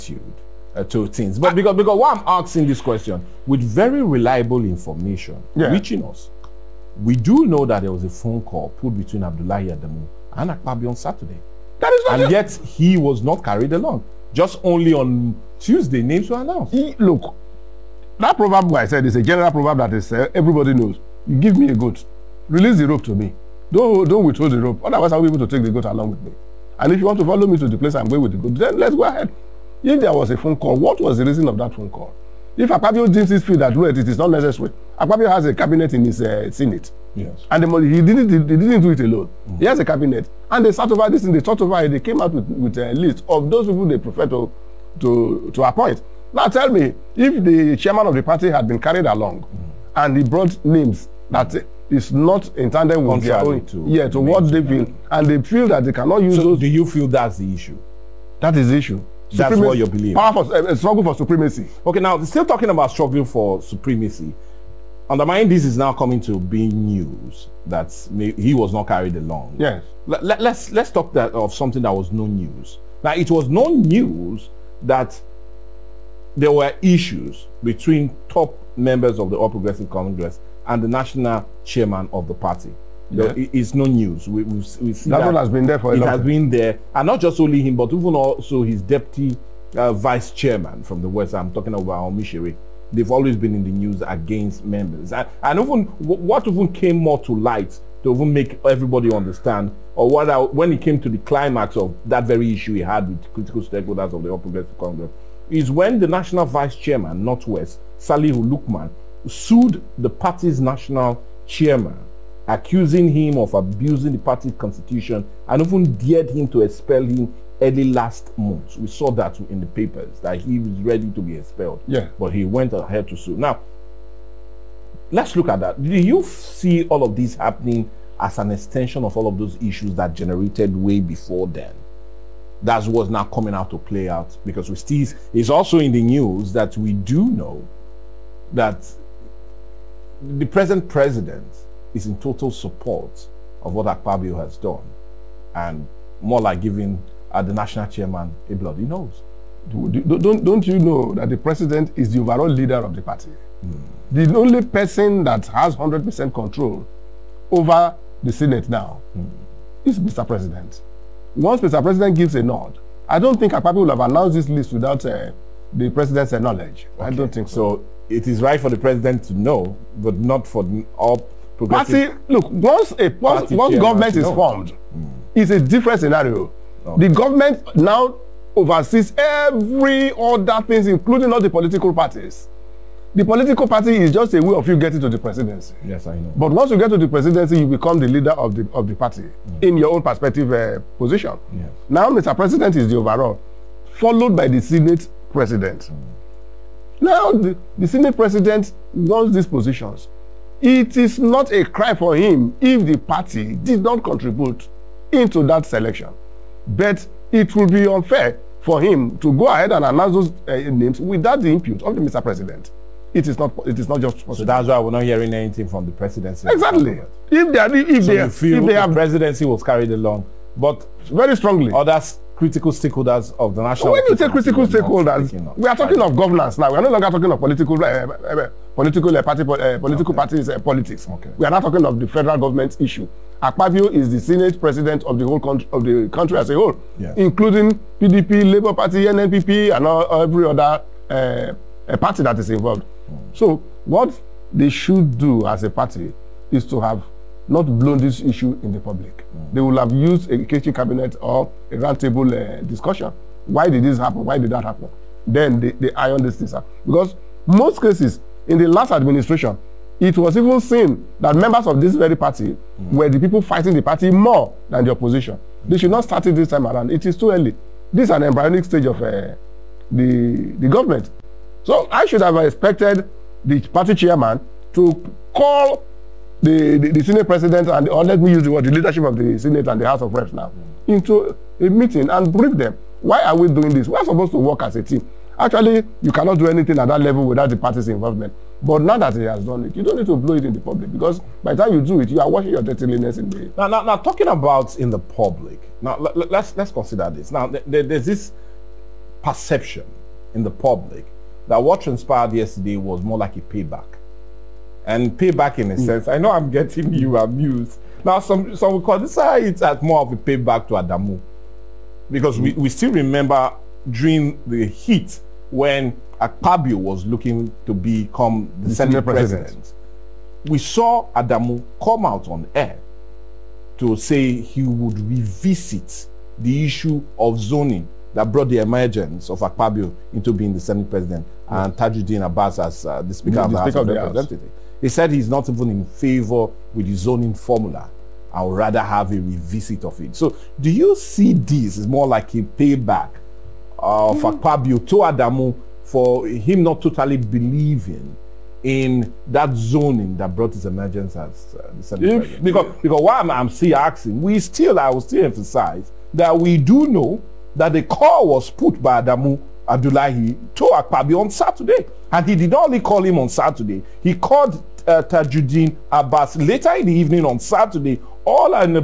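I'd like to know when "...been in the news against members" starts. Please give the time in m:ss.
1:33.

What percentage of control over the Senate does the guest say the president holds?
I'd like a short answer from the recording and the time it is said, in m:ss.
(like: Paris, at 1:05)
100%, at 2:35.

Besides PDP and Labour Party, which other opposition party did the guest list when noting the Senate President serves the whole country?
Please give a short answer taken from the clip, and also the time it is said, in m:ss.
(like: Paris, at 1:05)
NNPP, at 3:59.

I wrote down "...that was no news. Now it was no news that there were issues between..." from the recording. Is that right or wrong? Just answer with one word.
right.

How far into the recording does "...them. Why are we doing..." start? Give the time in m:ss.
4:42.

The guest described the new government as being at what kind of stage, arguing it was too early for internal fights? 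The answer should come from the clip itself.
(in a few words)
embryonic.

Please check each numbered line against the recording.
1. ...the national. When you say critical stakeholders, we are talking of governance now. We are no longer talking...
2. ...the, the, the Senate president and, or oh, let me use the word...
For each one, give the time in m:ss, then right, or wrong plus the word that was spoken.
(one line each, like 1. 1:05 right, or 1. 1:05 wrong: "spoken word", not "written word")
1. 3:43 right
2. 4:36 right.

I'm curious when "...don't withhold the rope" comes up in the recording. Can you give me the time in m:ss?
0:24.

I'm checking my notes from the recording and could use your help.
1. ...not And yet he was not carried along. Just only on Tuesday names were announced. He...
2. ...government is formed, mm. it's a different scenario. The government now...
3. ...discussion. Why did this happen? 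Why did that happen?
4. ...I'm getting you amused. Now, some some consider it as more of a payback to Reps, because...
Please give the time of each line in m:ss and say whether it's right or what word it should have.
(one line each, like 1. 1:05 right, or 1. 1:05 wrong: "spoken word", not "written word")
1. 0:12 right
2. 2:53 right
3. 4:12 right
4. 5:06 wrong: "Adamu", not "Reps".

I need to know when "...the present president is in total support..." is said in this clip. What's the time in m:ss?
2:20.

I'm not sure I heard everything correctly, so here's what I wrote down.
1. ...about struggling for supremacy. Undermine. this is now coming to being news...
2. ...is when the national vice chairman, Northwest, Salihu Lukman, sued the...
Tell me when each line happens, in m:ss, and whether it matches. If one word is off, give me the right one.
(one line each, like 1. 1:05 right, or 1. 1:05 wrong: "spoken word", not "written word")
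1. 1:02 right
2. 1:45 right.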